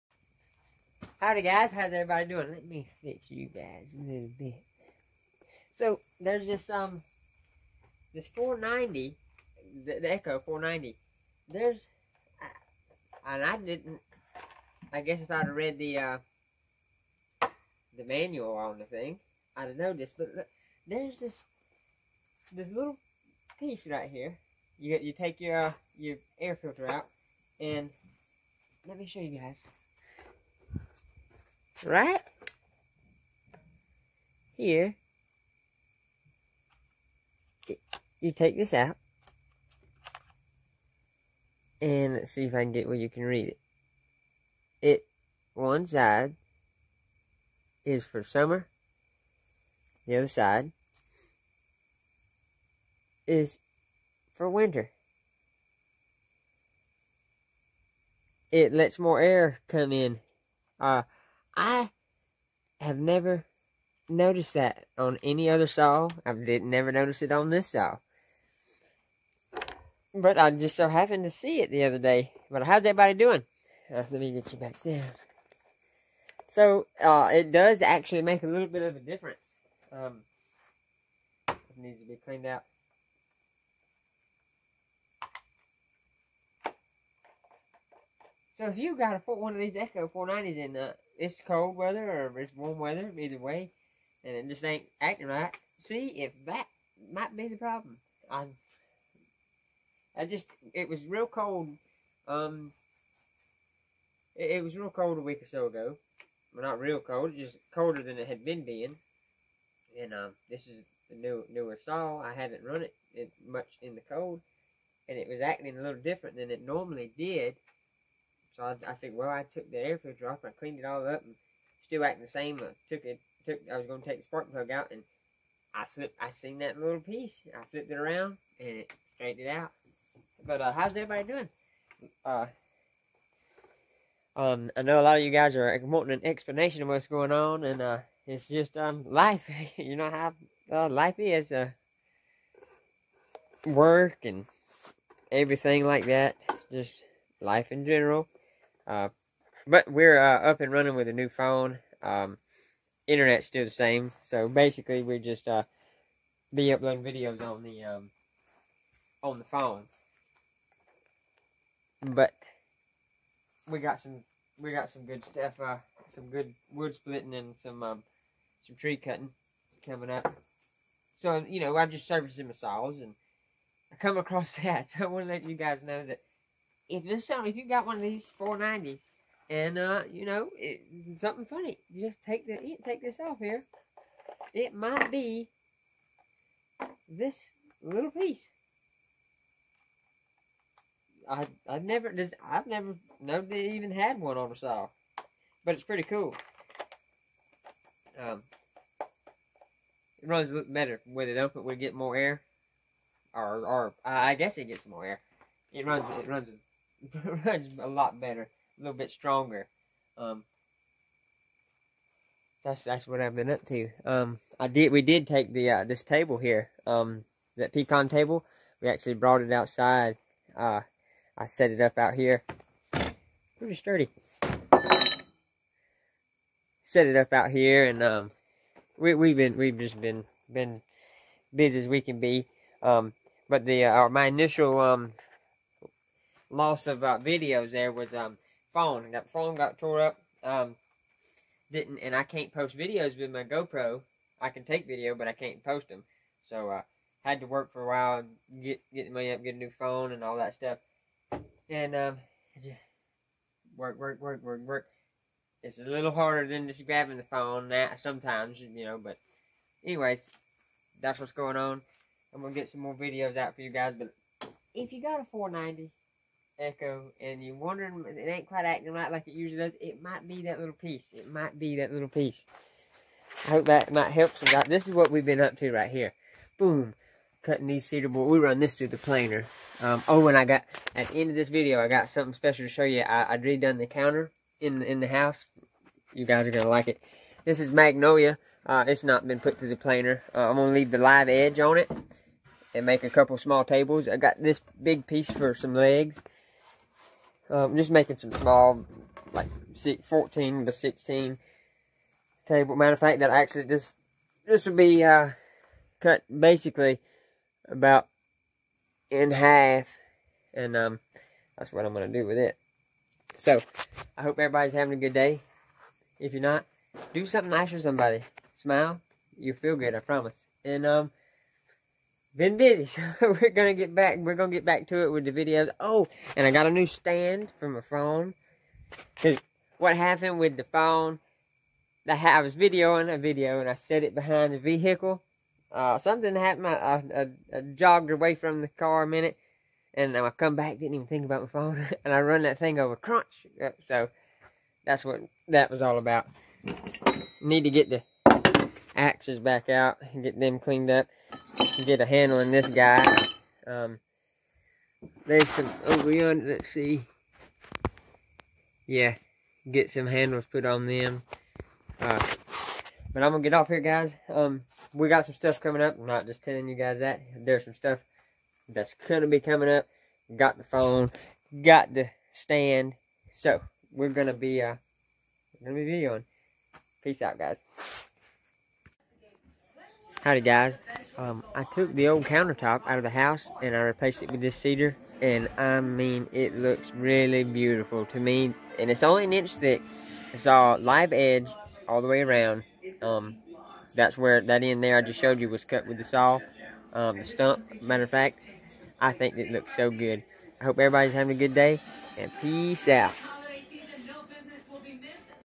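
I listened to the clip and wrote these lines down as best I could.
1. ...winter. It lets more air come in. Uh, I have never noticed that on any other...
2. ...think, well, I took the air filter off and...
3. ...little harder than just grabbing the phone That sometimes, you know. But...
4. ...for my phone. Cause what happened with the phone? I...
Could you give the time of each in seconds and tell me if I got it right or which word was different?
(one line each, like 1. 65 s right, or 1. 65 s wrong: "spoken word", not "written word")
1. 54 s right
2. 118 s right
3. 255 s right
4. 327 s right.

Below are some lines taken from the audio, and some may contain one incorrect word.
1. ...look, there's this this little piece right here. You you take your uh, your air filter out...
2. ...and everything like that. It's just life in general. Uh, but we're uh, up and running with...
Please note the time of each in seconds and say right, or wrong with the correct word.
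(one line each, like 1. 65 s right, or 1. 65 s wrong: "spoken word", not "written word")
1. 20 s right
2. 144 s right.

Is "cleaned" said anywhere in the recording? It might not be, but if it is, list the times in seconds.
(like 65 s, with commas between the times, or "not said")
82 s, 120 s, 350 s.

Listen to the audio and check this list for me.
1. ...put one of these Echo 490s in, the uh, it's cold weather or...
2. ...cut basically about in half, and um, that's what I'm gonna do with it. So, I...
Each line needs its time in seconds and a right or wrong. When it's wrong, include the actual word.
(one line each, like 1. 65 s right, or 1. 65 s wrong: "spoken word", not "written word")
1. 89 s right
2. 305 s right.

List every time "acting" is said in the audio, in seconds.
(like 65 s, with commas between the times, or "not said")
94 s, 115 s, 122 s, 268 s.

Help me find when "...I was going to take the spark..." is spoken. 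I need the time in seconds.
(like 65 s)
123 s.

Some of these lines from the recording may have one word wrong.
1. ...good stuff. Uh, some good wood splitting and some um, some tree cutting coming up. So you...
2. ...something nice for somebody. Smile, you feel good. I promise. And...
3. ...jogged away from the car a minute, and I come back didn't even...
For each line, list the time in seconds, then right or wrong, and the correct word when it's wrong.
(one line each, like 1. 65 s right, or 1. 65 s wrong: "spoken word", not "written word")
1. 165 s right
2. 317 s right
3. 337 s right.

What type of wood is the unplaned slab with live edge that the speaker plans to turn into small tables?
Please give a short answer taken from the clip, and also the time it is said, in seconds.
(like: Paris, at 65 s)
Magnolia, at 287 s.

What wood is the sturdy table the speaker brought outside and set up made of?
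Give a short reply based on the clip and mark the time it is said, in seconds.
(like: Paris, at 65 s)
Pecan, at 217 s.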